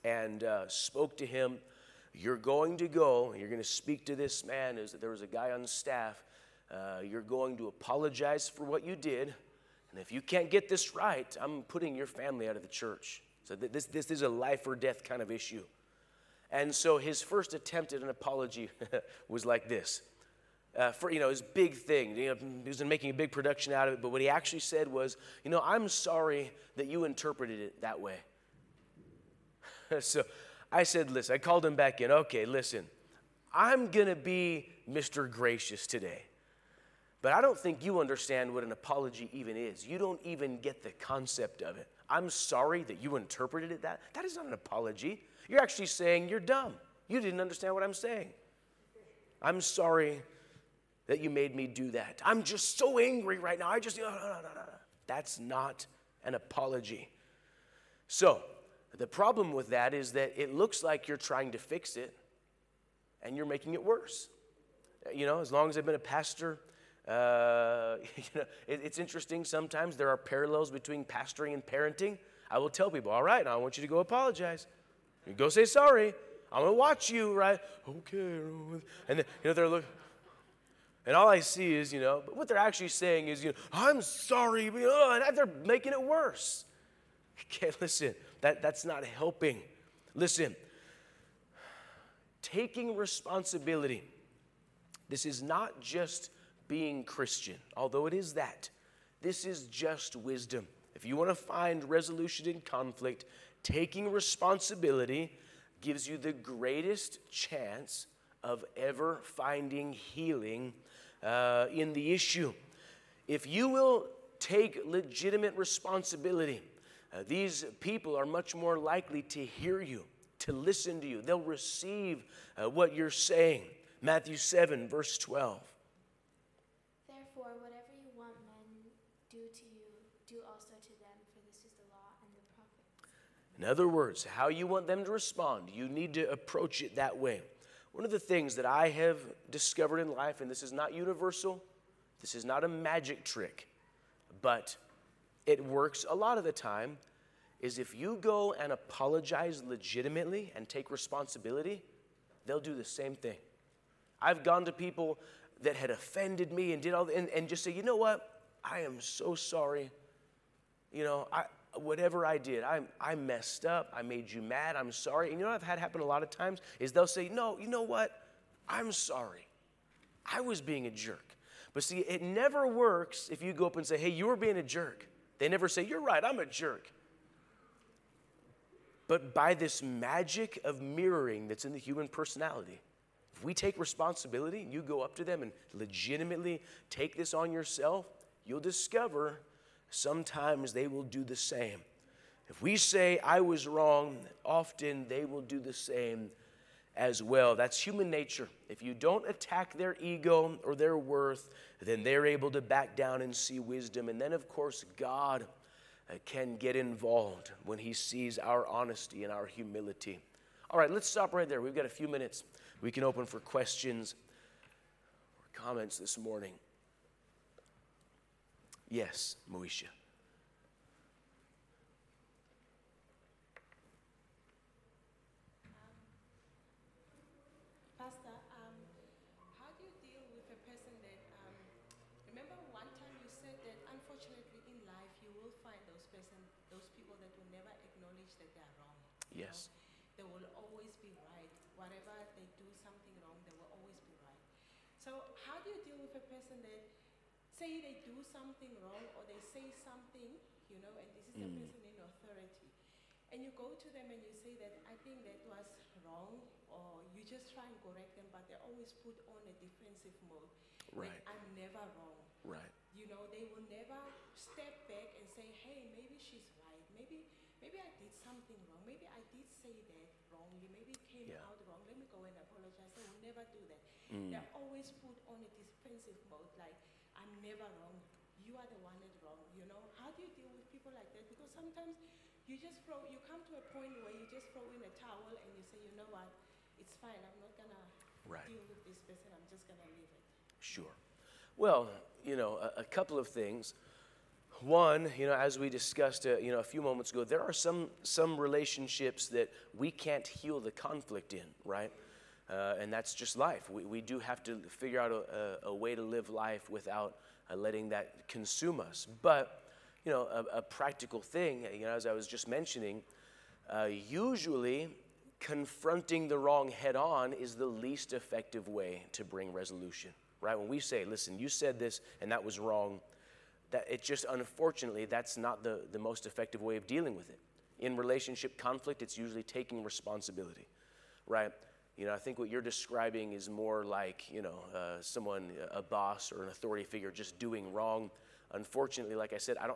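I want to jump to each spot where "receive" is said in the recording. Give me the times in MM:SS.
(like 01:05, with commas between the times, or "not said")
02:01.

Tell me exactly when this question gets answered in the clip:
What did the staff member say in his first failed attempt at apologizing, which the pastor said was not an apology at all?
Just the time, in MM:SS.
00:25.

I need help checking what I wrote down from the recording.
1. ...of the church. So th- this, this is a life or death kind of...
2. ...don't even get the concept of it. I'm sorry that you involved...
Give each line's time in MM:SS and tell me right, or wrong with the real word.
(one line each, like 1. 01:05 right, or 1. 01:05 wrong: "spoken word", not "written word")
1. 00:12 right
2. 00:39 wrong: "interpreted", not "involved".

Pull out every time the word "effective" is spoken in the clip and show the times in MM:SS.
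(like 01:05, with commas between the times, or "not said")
05:18, 05:26.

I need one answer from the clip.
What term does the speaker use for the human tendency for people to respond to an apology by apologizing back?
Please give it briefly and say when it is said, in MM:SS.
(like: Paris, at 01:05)
Mirroring, at 03:00.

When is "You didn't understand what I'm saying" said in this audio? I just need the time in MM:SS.
00:47.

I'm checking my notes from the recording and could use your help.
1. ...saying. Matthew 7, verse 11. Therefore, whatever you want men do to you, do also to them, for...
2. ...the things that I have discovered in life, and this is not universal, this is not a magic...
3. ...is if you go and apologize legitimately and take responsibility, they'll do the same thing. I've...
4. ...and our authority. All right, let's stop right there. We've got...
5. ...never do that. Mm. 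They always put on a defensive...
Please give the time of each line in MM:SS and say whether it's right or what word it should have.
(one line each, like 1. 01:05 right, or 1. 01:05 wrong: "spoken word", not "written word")
1. 02:03 wrong: "12", not "11"
2. 02:18 right
3. 02:27 right
4. 03:29 wrong: "humility", not "authority"
5. 04:33 right.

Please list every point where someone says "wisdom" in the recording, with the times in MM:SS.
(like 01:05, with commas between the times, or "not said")
01:40, 03:23.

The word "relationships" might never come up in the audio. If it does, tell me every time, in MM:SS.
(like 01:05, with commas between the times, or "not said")
04:58, 05:27.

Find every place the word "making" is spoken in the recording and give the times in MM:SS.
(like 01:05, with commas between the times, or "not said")
00:22, 01:03, 01:25.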